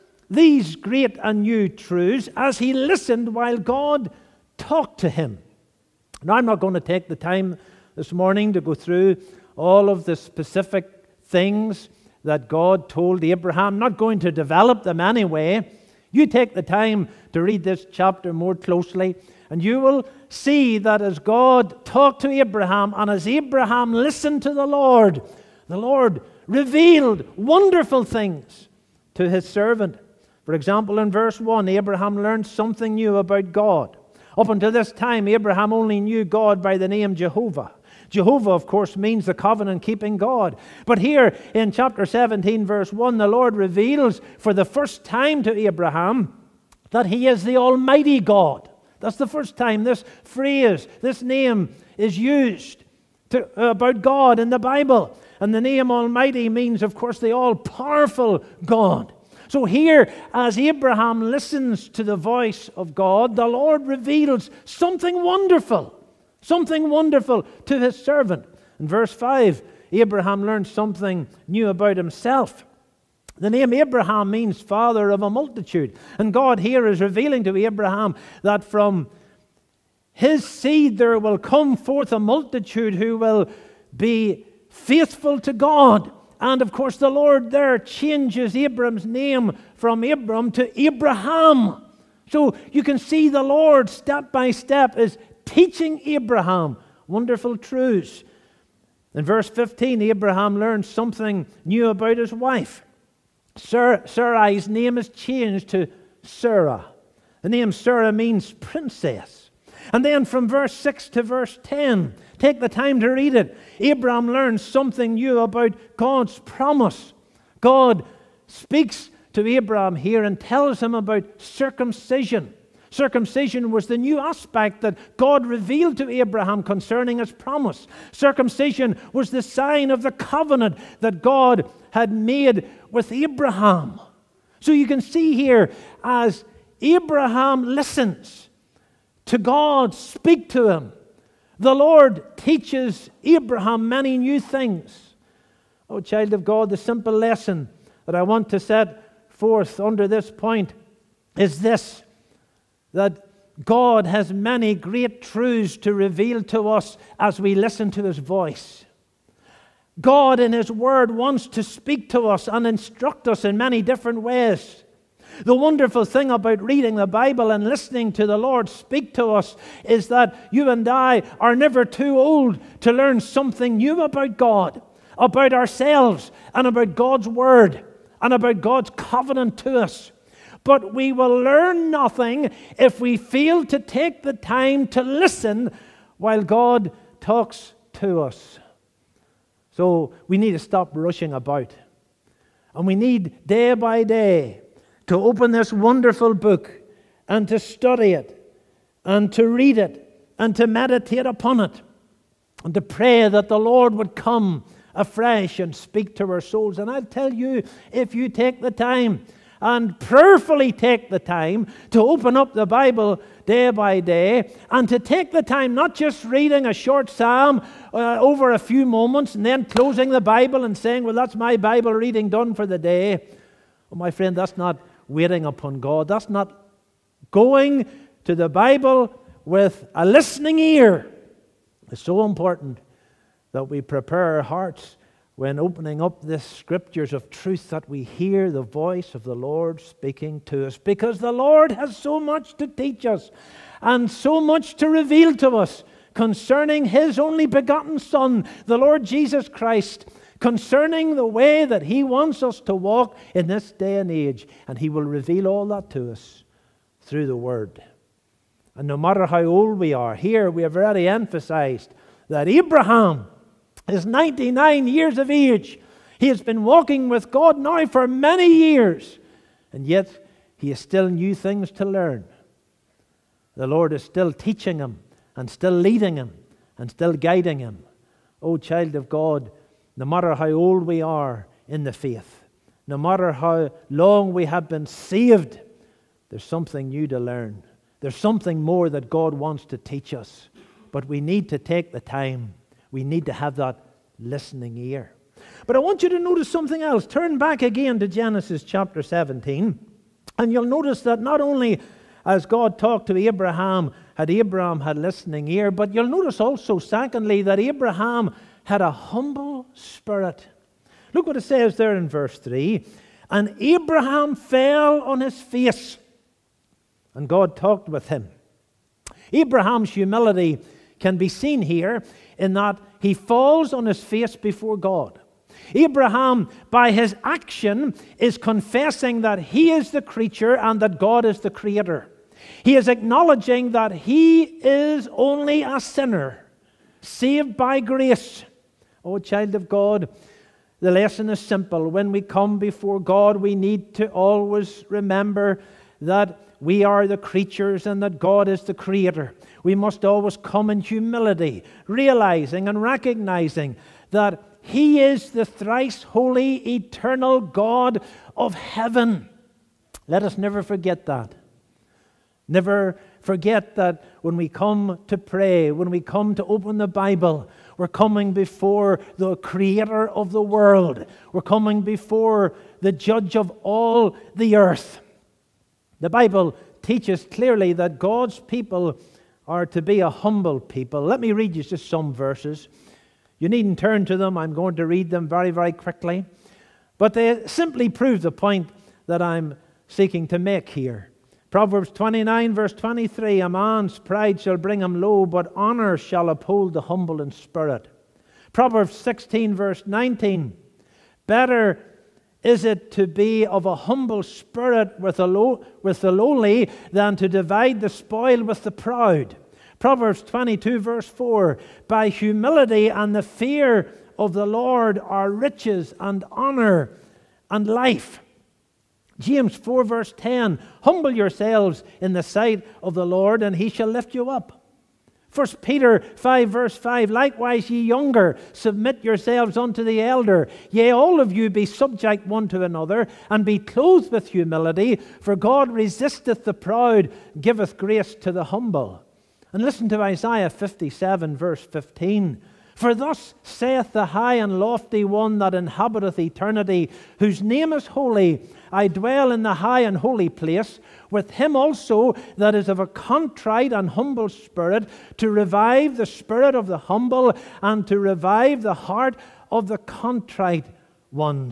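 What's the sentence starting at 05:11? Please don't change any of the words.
Look what it says there in verse 3 And Abraham fell on his face, and God talked with him.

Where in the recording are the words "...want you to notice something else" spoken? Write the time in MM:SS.
04:55.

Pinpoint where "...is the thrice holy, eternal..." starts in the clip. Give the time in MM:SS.
05:55.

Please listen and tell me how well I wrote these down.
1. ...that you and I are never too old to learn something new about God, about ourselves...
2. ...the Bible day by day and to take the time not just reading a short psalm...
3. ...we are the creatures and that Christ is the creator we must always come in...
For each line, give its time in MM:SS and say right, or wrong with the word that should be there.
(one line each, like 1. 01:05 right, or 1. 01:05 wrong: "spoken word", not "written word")
1. 02:50 right
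2. 03:32 right
3. 05:46 wrong: "God", not "Christ".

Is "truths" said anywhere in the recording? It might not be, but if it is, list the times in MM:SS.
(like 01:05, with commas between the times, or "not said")
00:01, 01:37, 02:35, 03:57.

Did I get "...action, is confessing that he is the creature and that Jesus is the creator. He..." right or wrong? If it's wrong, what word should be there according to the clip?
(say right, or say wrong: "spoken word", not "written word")
wrong: "God", not "Jesus".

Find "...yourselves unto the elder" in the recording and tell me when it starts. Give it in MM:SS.
07:09.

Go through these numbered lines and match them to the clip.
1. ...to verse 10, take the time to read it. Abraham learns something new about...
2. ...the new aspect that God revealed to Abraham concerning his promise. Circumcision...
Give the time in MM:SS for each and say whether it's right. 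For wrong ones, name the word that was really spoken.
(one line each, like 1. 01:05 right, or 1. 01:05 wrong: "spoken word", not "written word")
1. 01:51 right
2. 02:03 right.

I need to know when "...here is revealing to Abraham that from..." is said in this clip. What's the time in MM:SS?
01:16.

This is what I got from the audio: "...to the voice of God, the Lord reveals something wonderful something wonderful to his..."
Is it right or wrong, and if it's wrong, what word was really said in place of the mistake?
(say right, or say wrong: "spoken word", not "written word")
right.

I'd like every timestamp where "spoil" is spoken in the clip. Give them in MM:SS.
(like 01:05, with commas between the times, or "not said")
06:47.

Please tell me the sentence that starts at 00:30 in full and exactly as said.
For example, in verse 1, Abraham learned something new about God.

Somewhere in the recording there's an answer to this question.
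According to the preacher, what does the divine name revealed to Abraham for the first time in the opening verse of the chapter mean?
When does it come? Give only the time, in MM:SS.
00:57.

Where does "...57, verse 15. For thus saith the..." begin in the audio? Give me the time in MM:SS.
07:20.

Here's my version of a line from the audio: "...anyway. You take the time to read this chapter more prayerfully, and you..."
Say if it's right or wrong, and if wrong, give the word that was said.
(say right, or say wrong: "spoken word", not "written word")
wrong: "closely", not "prayerfully".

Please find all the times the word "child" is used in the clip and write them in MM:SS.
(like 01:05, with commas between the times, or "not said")
02:25, 04:38, 05:39.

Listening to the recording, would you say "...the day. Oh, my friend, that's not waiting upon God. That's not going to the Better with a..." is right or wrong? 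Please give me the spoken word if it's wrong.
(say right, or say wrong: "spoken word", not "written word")
wrong: "Bible", not "Better".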